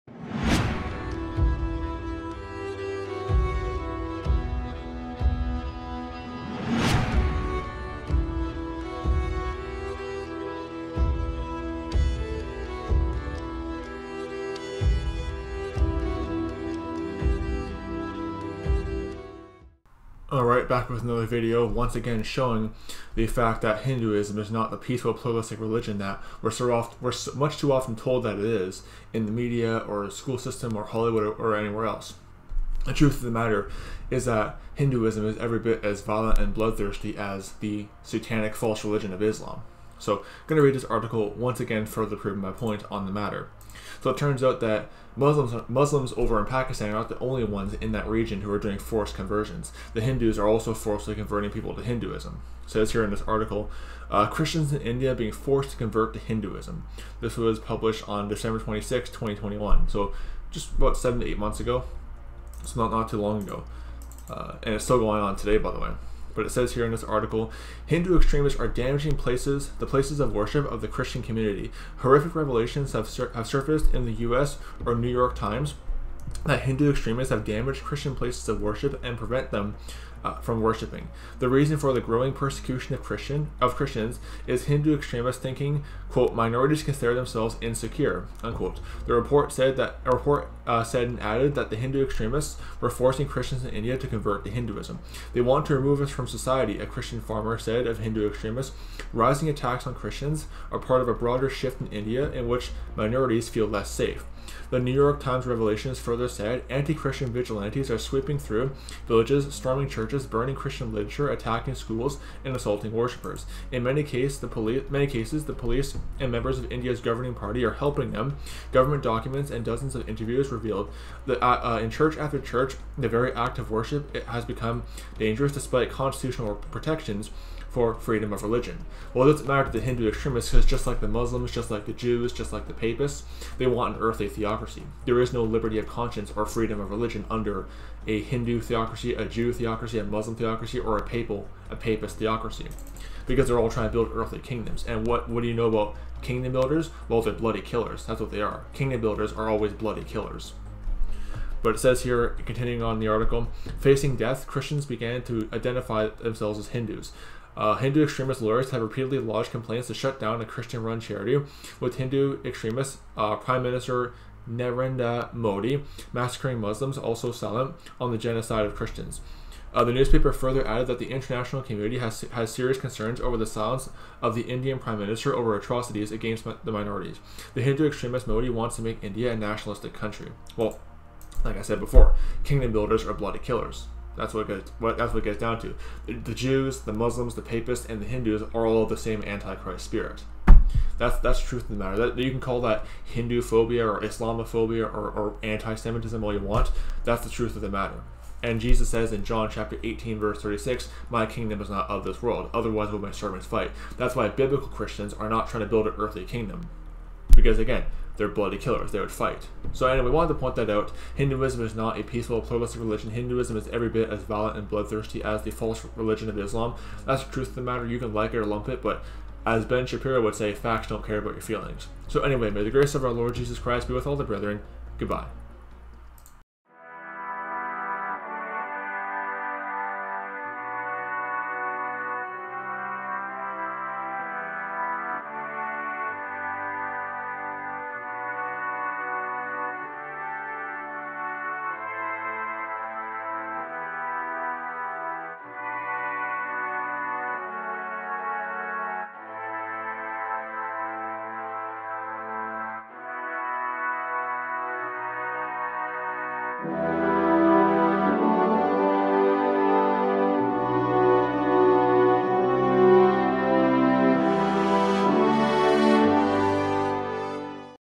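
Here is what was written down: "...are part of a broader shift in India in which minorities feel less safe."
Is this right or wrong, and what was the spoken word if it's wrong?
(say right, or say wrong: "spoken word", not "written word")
right.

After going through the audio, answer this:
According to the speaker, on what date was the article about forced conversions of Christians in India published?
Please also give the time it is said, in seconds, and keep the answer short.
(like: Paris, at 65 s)
December 26, 2021, at 58 s.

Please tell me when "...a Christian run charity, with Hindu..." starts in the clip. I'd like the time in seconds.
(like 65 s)
160 s.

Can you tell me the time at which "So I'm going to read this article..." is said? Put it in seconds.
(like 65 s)
40 s.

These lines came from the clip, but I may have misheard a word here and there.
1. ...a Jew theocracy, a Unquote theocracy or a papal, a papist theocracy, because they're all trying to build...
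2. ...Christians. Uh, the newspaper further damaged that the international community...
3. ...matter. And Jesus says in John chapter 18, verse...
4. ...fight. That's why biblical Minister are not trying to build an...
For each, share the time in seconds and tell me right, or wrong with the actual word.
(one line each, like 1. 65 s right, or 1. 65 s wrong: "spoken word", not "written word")
1. 139 s wrong: "Muslim", not "Unquote"
2. 168 s wrong: "added", not "damaged"
3. 197 s right
4. 203 s wrong: "Christians", not "Minister".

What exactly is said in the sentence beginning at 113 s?
In many, cases, the police, many cases, the police and members of India's governing party are helping them.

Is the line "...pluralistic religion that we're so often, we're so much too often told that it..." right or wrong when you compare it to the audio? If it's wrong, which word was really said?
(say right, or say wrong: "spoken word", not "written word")
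right.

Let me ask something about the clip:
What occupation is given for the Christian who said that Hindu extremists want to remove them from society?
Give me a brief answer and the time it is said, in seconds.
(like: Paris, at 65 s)
Farmer, at 97 s.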